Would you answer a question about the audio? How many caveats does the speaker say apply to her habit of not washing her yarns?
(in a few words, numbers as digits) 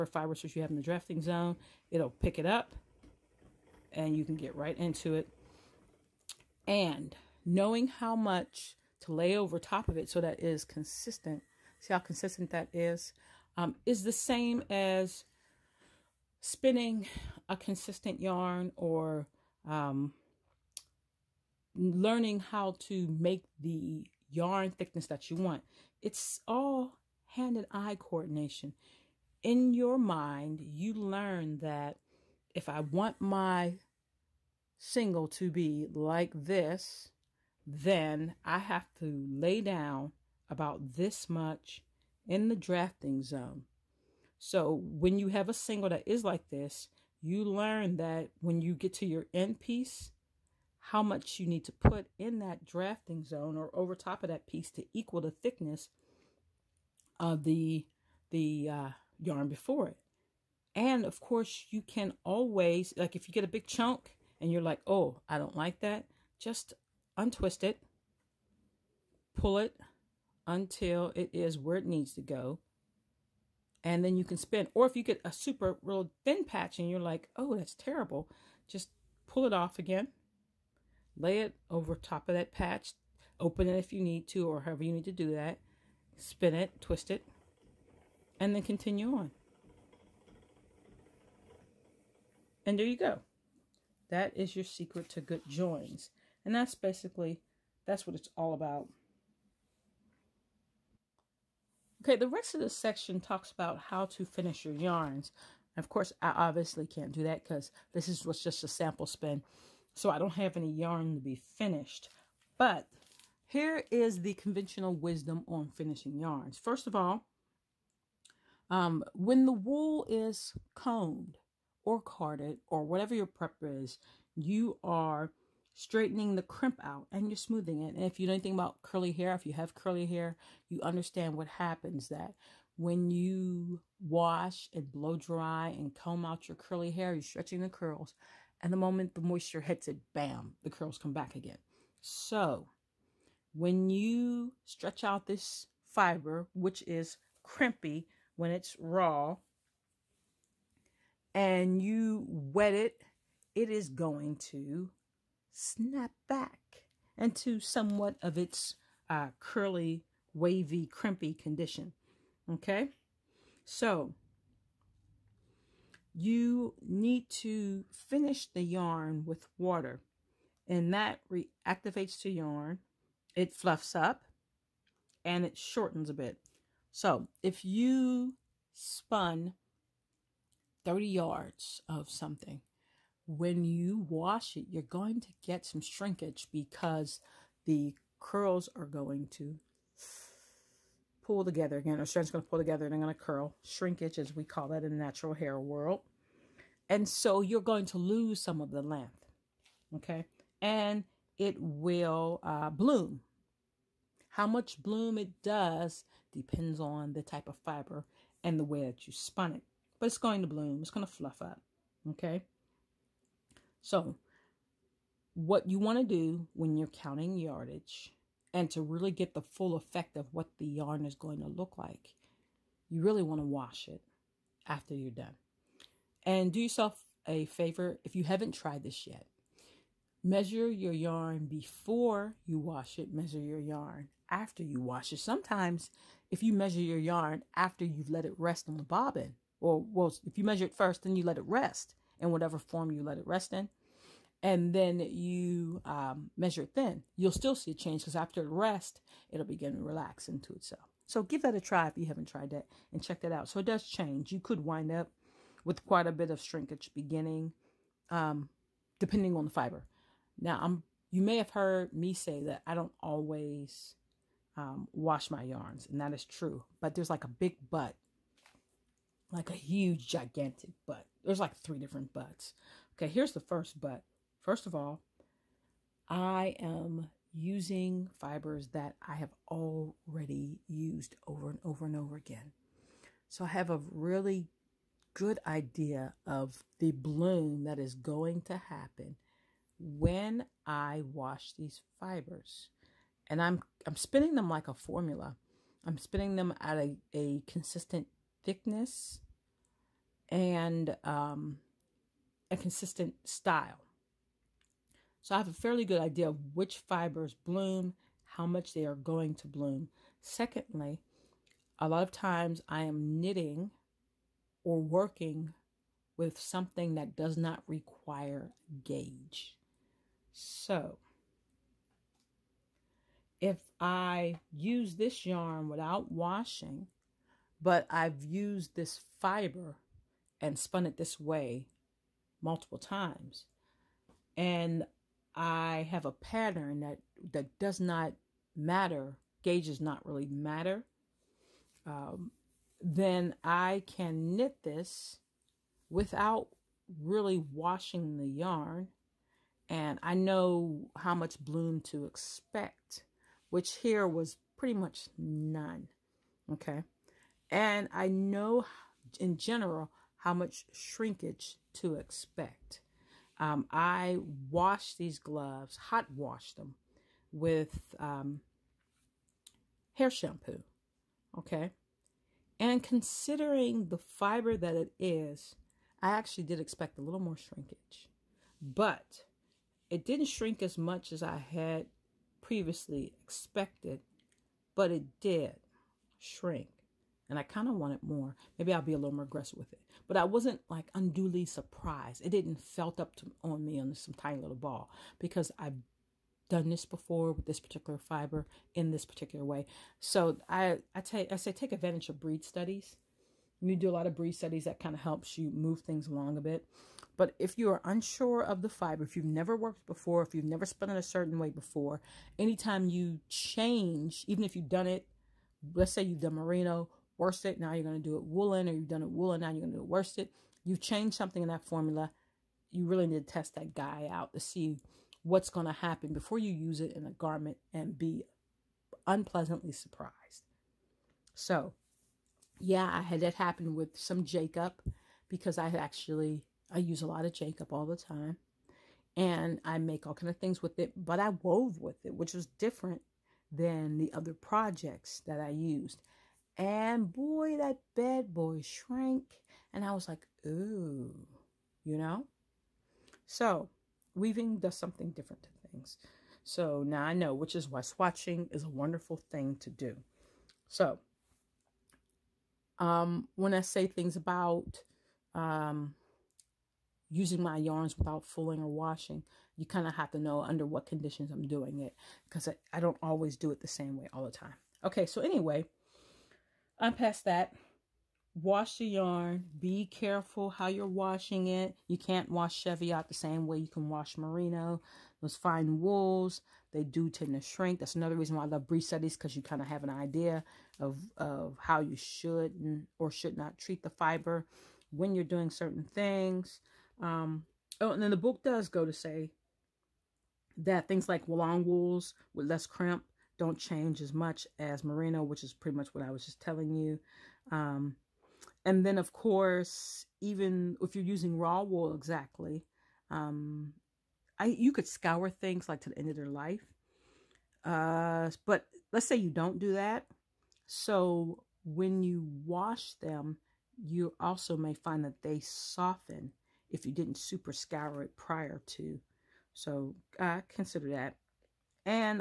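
3.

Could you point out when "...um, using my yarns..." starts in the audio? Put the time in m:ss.
7:45.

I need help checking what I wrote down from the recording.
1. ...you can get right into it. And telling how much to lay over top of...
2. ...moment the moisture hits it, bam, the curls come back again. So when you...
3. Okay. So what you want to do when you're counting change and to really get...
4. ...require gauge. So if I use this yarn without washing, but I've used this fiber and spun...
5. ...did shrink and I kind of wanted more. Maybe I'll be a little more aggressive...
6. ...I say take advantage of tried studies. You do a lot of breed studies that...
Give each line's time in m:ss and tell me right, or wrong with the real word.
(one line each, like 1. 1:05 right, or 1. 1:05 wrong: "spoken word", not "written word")
1. 0:04 wrong: "knowing", not "telling"
2. 2:18 right
3. 3:32 wrong: "yardage", not "change"
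4. 5:17 right
5. 6:25 right
6. 6:41 wrong: "breed", not "tried".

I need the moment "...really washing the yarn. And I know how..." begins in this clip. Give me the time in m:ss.
5:47.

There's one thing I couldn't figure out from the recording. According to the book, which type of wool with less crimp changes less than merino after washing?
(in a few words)
Long wools.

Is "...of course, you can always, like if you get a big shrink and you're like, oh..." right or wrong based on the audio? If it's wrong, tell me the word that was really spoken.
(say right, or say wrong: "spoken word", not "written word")
wrong: "chunk", not "shrink".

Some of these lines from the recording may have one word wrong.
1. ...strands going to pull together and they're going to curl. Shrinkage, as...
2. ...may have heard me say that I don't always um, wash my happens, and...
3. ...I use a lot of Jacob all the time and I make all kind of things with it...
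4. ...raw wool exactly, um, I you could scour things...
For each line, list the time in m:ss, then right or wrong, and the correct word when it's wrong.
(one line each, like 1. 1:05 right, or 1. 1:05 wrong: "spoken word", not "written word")
1. 3:12 right
2. 4:21 wrong: "yarns", not "happens"
3. 7:16 right
4. 8:31 right.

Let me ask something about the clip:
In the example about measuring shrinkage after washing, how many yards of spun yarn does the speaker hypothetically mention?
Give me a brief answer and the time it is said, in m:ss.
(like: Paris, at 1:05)
30, at 3:00.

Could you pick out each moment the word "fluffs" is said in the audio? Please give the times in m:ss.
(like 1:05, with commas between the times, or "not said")
2:53, 3:31.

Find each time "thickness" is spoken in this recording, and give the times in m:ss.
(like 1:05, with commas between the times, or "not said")
0:24, 0:55, 4:58.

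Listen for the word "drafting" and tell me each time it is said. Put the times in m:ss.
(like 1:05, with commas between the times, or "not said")
0:00, 0:42, 0:52.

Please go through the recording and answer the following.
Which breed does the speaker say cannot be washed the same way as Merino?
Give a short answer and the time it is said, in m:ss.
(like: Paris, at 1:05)
Cheviot, at 8:02.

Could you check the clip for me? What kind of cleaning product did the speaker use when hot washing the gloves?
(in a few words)
Hair shampoo.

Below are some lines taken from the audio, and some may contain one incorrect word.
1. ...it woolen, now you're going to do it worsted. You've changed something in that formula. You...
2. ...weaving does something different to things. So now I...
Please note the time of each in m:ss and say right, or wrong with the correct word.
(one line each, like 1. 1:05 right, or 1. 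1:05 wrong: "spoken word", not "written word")
1. 6:59 right
2. 7:34 right.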